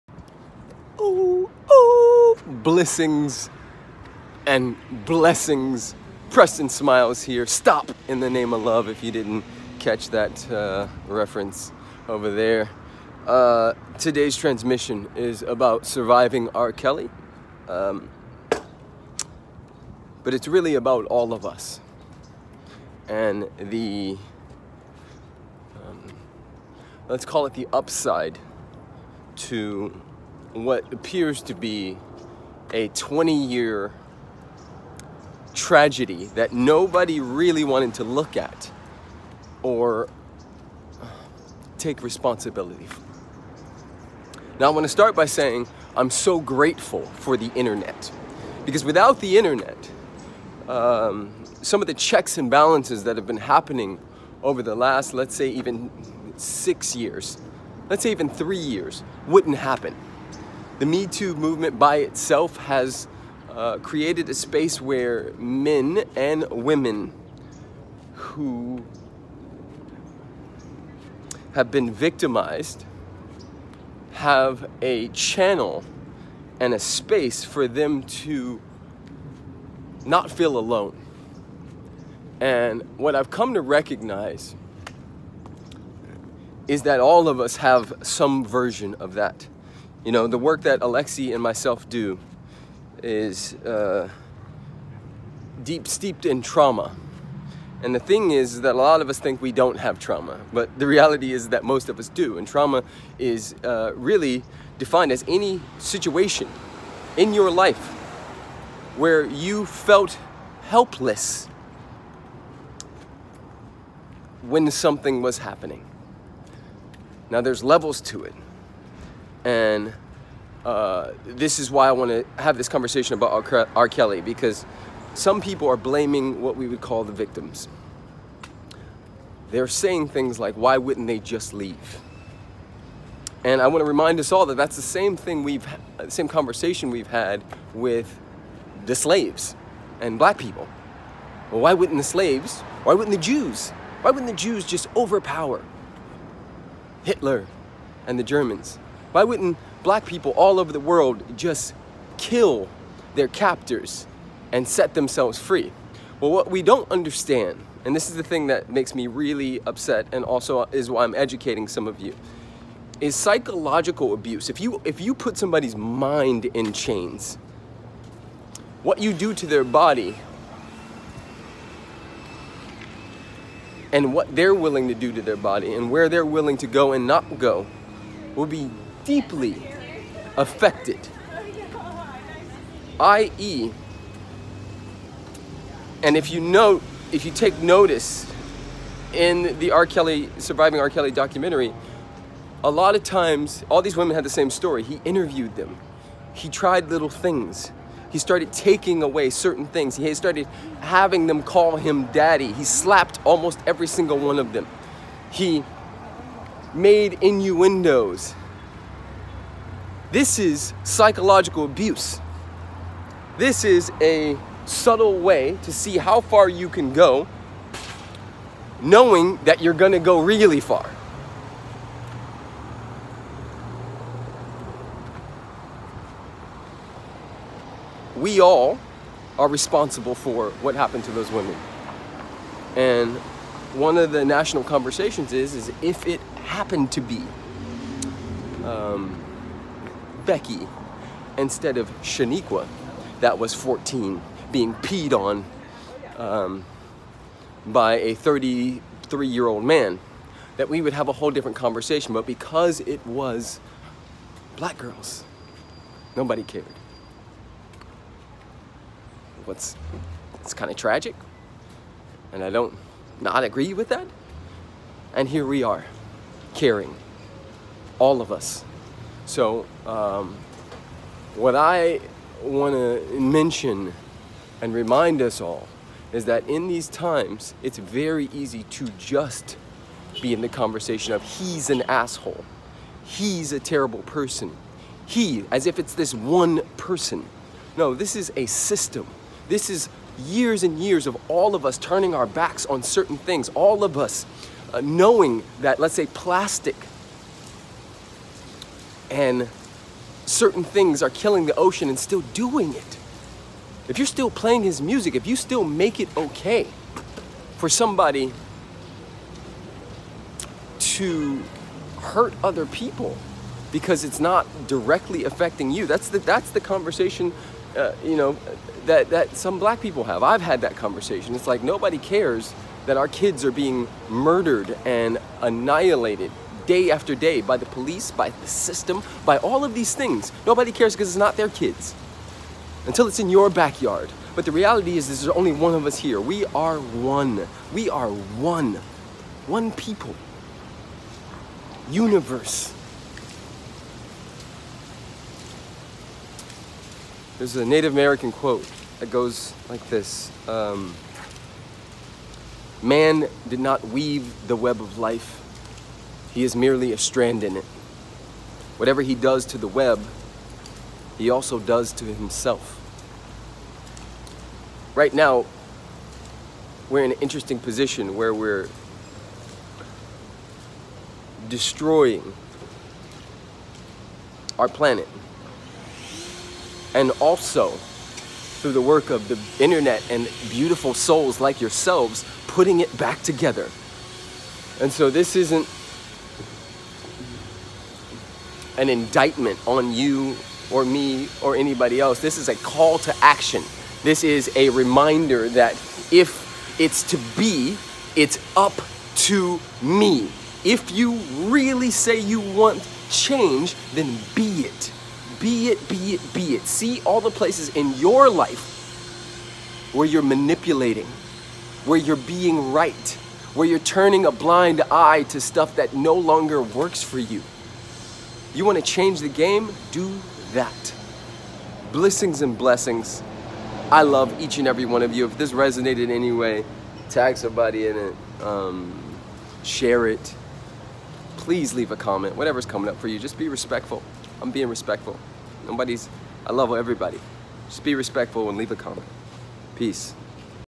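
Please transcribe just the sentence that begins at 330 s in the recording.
Nobody cares because it's not their kids.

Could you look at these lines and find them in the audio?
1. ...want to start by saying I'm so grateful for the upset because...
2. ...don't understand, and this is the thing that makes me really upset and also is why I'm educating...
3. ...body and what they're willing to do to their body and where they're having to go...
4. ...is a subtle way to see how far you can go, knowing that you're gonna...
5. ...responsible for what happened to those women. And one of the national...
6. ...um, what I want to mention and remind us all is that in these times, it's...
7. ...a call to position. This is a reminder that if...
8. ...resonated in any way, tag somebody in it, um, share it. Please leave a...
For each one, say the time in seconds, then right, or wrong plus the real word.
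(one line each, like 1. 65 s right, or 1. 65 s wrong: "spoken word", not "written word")
1. 44 s wrong: "internet", not "upset"
2. 156 s right
3. 169 s wrong: "willing", not "having"
4. 213 s right
5. 229 s right
6. 269 s right
7. 392 s wrong: "action", not "position"
8. 425 s right.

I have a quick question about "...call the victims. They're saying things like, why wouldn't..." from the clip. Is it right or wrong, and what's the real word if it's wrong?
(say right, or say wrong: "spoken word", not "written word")
right.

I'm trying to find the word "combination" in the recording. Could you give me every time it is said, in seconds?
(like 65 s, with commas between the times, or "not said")
not said.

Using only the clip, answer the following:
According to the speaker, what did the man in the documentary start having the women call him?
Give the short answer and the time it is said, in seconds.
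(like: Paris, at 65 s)
Daddy, at 202 s.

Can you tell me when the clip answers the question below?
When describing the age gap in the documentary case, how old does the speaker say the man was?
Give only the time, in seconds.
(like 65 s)
248 s.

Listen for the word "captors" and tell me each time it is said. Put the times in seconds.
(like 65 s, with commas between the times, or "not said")
153 s.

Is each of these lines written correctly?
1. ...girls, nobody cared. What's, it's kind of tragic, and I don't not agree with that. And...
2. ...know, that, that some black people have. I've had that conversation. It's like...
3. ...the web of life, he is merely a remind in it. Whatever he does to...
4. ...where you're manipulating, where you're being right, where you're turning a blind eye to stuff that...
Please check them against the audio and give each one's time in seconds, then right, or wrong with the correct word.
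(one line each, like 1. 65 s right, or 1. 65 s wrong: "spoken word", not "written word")
1. 254 s right
2. 318 s right
3. 354 s wrong: "strand", not "remind"
4. 409 s right.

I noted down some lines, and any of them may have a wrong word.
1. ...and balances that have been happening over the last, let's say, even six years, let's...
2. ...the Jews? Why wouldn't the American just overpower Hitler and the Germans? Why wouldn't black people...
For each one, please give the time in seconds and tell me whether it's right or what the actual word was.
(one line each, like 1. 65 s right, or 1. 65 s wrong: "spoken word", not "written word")
1. 52 s right
2. 143 s wrong: "Jews", not "American".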